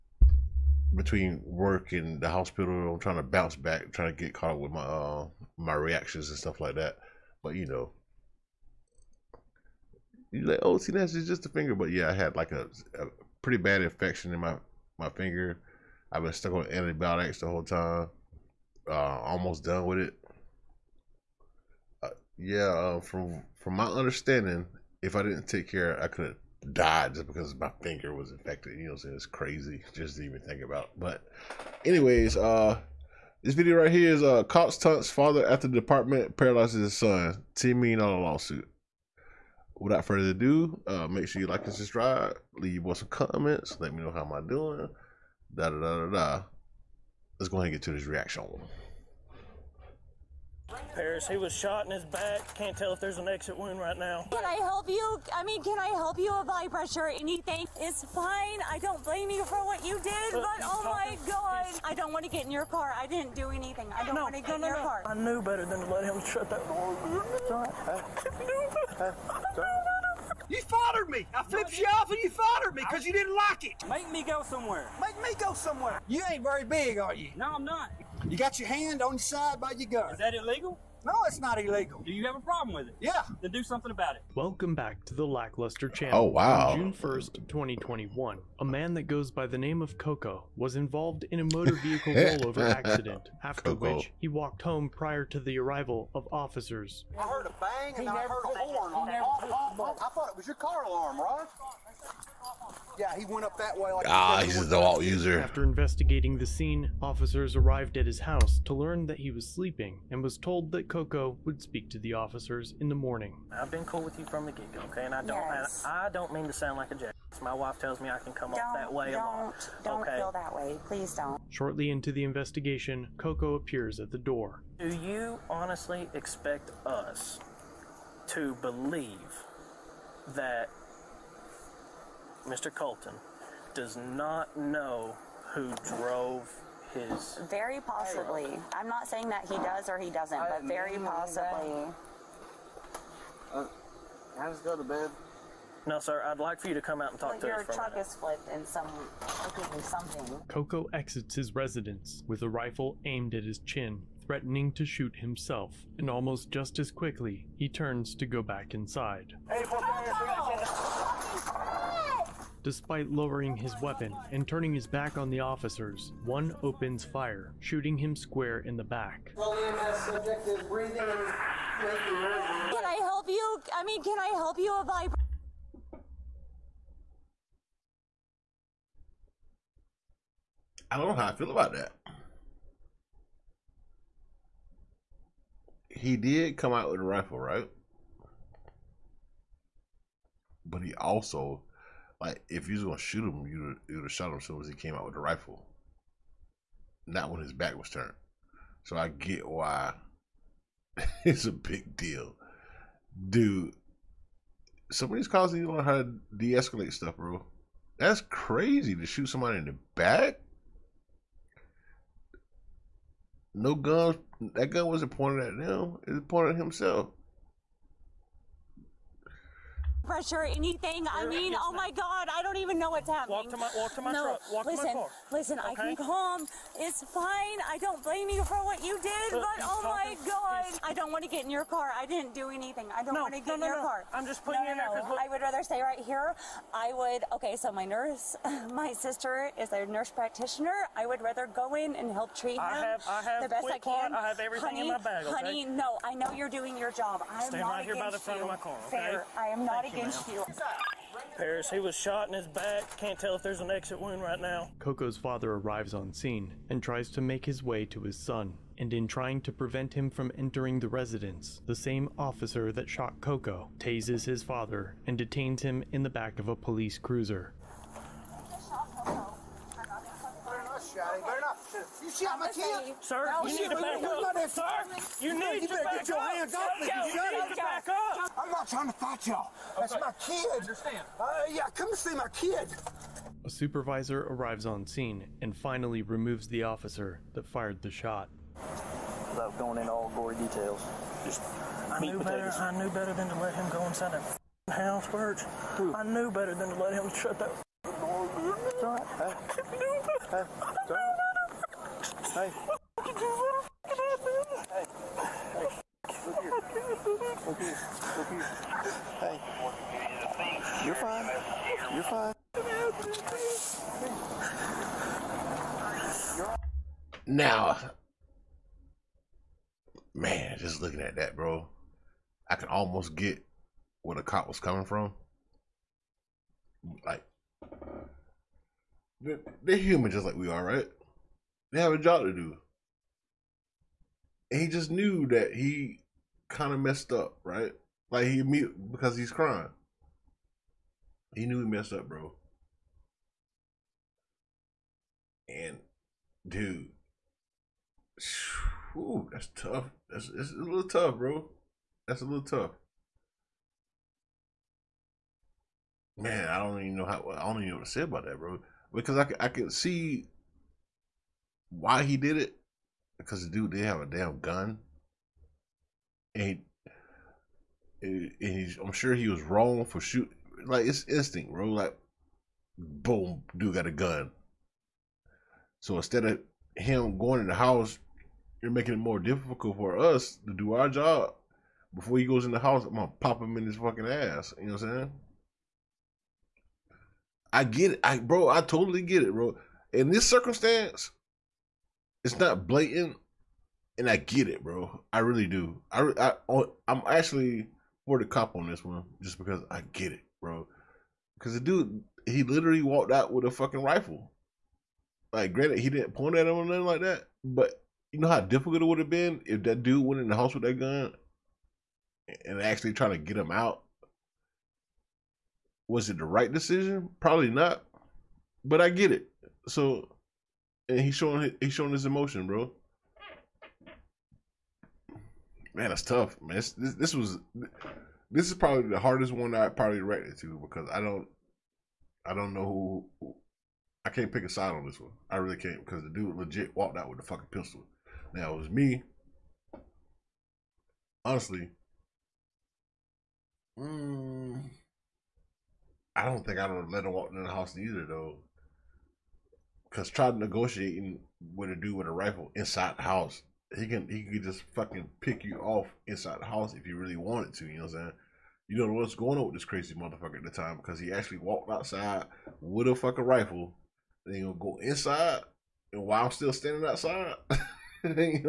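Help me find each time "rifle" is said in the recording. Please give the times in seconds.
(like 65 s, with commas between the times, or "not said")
152 s, 187 s, 195 s, 403 s, 452 s, 463 s.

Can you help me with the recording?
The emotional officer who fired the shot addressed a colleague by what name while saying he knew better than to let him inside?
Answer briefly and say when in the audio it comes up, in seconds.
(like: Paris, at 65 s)
Birch, at 295 s.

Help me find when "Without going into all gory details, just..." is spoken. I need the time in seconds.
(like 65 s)
288 s.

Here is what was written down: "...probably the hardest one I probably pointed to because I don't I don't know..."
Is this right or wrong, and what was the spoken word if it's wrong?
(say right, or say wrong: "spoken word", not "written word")
wrong: "reacted", not "pointed".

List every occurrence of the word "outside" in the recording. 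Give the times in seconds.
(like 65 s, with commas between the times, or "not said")
461 s, 466 s.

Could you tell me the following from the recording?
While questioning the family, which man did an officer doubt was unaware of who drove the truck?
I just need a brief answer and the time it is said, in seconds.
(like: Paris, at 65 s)
Mr. Colton, at 132 s.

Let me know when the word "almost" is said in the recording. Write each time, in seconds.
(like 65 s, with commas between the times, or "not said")
19 s, 156 s, 322 s.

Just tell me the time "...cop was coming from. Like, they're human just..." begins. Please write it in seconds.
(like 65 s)
324 s.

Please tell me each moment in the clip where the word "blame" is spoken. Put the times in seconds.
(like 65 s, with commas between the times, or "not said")
59 s, 228 s.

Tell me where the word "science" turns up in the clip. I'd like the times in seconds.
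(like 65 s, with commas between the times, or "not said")
not said.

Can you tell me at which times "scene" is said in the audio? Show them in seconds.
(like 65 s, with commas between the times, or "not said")
106 s, 256 s, 284 s.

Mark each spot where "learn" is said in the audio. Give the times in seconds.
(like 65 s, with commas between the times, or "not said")
108 s, 205 s.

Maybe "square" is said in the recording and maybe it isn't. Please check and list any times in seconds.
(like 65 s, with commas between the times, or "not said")
168 s.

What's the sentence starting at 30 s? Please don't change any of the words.
But anyways, uh this video right here is uh cops Tunt's father after the department paralyzes his son.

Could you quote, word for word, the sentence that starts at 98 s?
I thought it was your car alarm, right?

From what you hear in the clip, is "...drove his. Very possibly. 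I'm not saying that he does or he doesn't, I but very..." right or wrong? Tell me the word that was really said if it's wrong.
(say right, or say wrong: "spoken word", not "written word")
right.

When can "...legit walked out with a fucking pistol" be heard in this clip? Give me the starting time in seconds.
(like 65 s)
436 s.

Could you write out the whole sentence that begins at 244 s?
I have everything honey, in my bag.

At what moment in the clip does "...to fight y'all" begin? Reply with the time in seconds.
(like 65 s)
278 s.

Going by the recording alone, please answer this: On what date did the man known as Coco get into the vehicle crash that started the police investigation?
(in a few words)
June 1, 2021.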